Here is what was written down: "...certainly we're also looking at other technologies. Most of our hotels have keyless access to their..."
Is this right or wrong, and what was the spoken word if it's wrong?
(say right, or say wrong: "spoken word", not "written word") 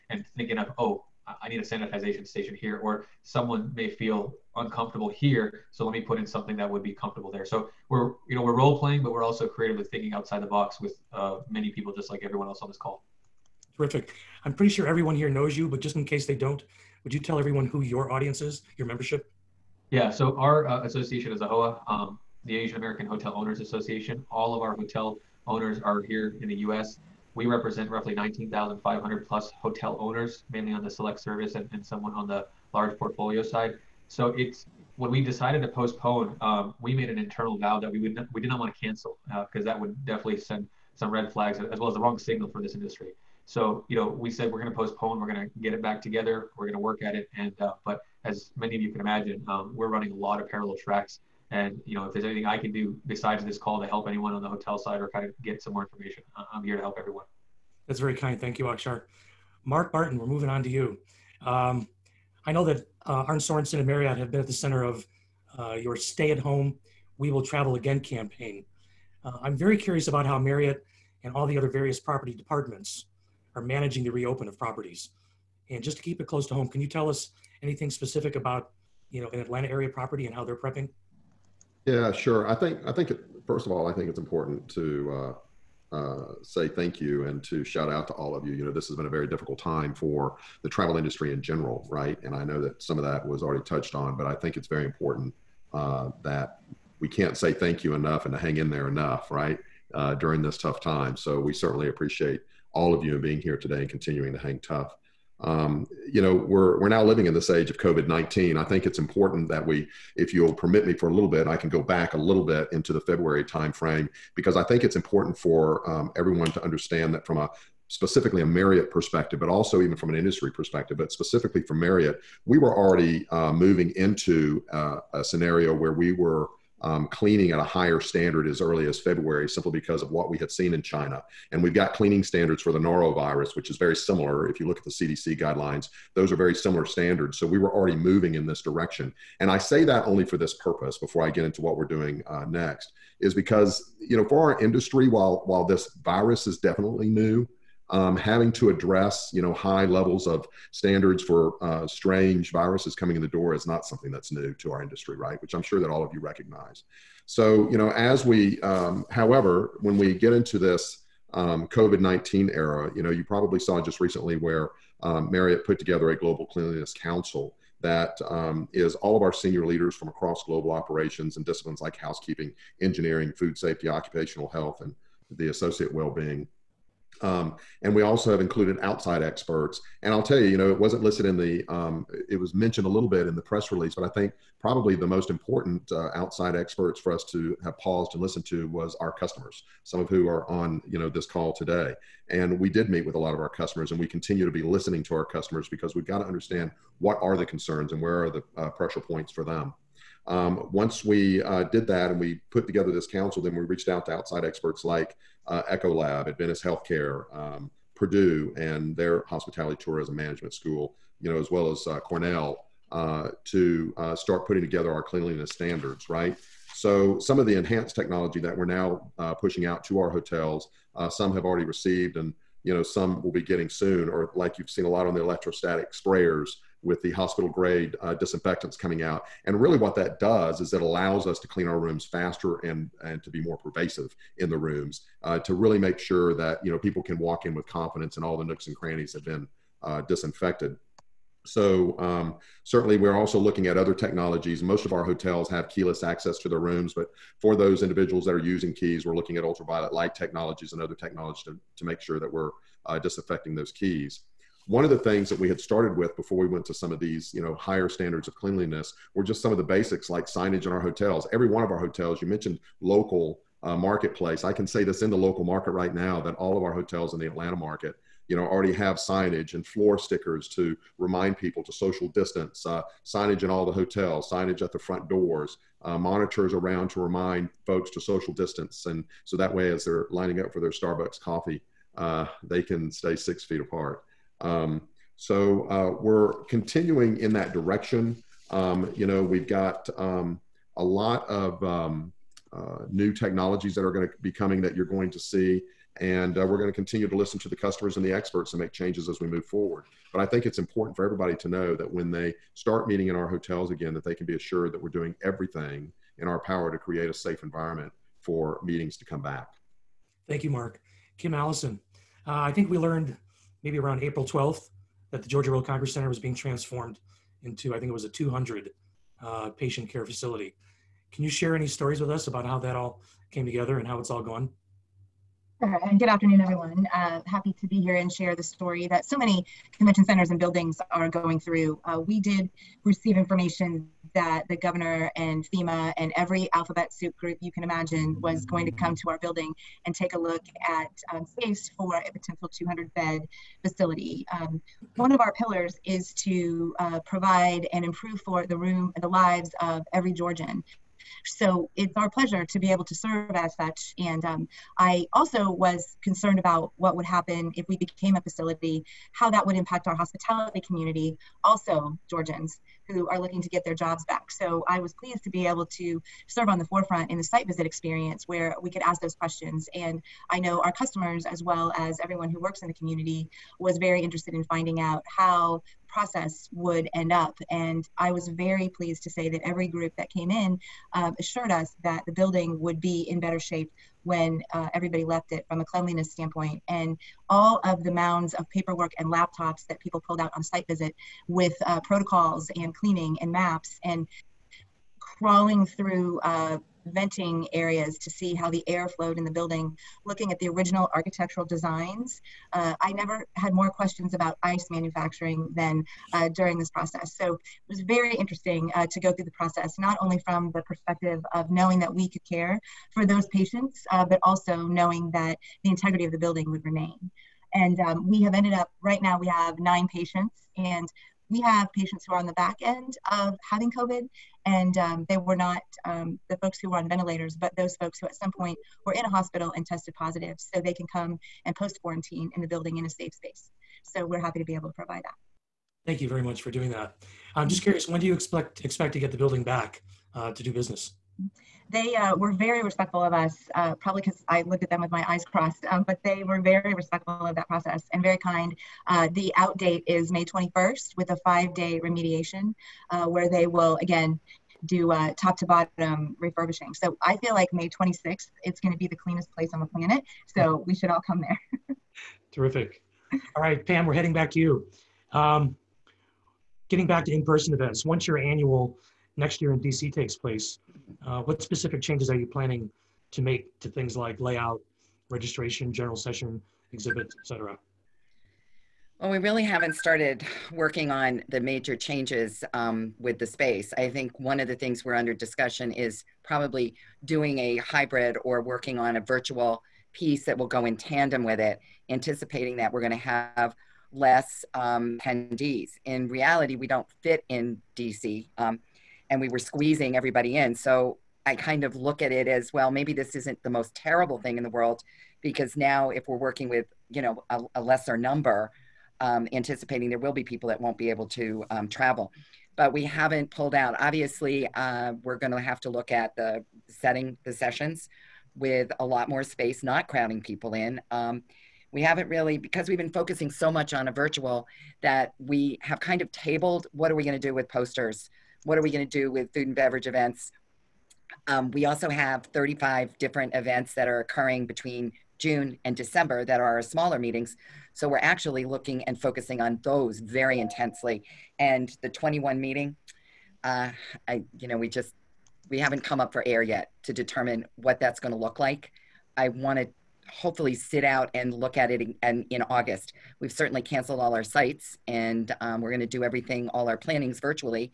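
right.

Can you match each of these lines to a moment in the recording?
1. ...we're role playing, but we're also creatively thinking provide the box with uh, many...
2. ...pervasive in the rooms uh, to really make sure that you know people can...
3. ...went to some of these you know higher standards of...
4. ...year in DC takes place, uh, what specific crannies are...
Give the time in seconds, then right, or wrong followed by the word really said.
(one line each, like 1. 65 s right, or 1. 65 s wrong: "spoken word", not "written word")
1. 8 s wrong: "outside", not "provide"
2. 233 s right
3. 256 s right
4. 469 s wrong: "changes", not "crannies".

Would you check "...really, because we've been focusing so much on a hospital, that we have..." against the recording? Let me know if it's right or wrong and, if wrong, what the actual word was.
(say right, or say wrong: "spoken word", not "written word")
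wrong: "virtual", not "hospital".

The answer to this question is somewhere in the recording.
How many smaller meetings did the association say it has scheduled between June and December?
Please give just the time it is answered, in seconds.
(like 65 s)
532 s.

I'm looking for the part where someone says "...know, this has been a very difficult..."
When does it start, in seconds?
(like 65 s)
88 s.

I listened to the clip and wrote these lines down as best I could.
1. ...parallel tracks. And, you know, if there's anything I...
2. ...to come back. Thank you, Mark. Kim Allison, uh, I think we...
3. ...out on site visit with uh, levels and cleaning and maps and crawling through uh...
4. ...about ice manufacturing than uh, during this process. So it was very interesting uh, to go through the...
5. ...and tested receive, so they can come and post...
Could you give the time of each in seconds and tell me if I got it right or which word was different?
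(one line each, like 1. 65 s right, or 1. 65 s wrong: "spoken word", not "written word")
1. 50 s right
2. 308 s right
3. 390 s wrong: "protocols", not "levels"
4. 404 s right
5. 429 s wrong: "positive", not "receive".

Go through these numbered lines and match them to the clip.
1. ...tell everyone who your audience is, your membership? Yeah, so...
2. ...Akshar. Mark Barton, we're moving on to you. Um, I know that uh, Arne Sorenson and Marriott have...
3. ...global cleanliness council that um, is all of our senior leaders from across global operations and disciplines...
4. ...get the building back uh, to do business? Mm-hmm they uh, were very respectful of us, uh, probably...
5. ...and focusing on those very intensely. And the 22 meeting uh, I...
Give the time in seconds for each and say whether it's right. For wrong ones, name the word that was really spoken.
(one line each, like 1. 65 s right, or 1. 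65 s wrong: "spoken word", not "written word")
1. 17 s right
2. 58 s right
3. 166 s right
4. 438 s right
5. 538 s wrong: "21", not "22".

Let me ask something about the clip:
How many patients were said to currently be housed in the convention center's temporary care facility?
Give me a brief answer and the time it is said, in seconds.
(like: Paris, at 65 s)
9, at 419 s.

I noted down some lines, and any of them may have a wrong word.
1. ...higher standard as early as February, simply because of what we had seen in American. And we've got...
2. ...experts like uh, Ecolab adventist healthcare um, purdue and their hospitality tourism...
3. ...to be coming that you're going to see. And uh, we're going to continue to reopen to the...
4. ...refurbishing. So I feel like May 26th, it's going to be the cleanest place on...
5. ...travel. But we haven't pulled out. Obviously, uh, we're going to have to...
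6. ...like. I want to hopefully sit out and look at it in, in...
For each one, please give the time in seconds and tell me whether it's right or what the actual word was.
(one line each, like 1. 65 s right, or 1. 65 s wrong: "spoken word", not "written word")
1. 127 s wrong: "China", not "American"
2. 204 s right
3. 294 s wrong: "listen", not "reopen"
4. 456 s right
5. 511 s right
6. 548 s right.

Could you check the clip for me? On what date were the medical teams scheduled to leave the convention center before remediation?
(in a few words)
May 21st.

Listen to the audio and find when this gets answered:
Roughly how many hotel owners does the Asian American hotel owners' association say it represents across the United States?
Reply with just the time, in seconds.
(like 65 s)
28 s.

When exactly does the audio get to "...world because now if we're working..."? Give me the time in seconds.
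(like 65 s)
504 s.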